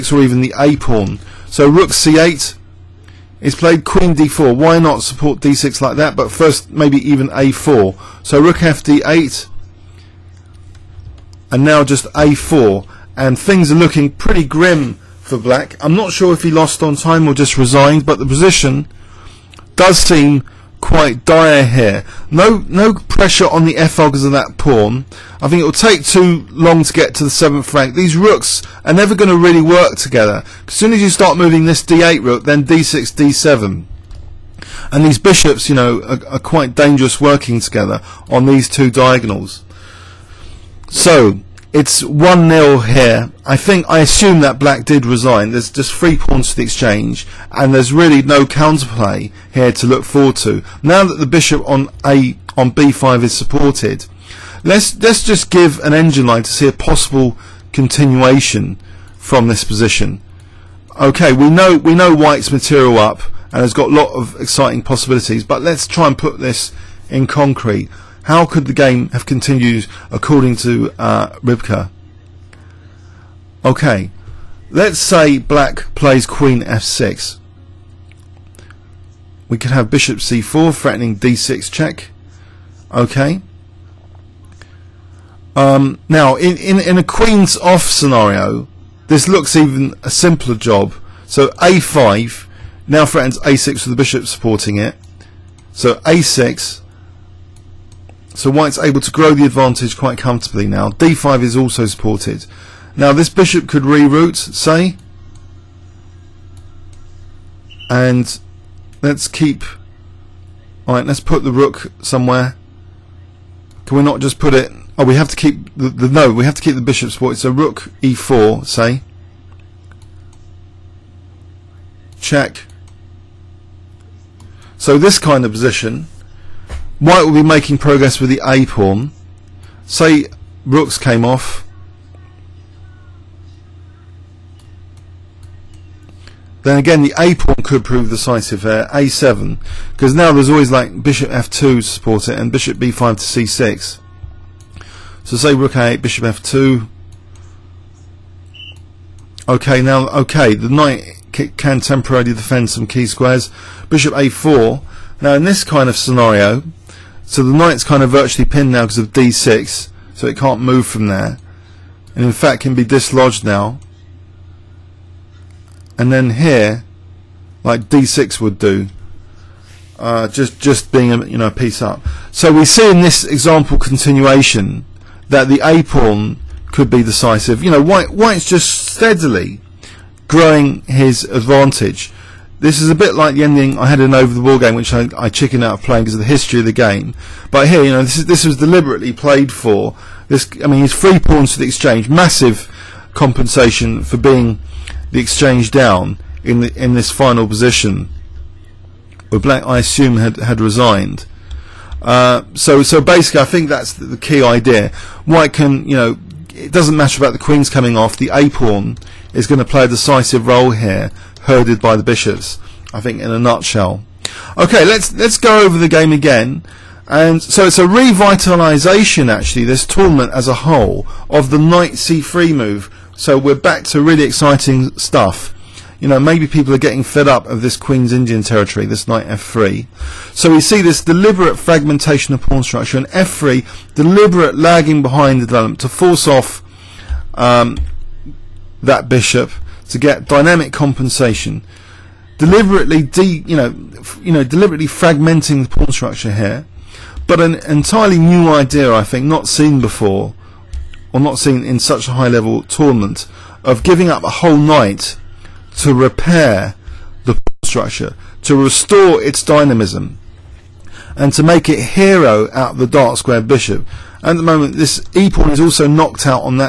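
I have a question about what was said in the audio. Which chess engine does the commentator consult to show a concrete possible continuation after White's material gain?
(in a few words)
Rybka.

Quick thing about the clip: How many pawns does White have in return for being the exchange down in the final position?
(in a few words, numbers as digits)
3.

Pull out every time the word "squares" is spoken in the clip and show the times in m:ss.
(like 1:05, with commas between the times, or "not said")
2:33, 4:23.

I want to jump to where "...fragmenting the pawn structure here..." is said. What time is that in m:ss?
4:04.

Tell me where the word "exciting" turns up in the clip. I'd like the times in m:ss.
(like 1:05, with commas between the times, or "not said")
1:04, 3:44.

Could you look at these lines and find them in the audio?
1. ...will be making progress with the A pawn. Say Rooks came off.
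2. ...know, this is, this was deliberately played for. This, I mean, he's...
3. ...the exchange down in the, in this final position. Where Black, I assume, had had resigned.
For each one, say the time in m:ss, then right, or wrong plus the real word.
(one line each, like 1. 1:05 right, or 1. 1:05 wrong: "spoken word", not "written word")
1. 2:07 right
2. 3:07 right
3. 3:15 right.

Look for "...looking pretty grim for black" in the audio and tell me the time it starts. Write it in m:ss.
0:13.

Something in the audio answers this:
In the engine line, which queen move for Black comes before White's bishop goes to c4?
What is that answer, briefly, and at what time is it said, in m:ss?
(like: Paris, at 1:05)
Queen f6, at 1:16.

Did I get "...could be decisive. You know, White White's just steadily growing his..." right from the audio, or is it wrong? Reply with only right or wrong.
right.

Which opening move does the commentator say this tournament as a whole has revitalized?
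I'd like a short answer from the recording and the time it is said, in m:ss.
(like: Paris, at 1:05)
Knight c3, at 3:41.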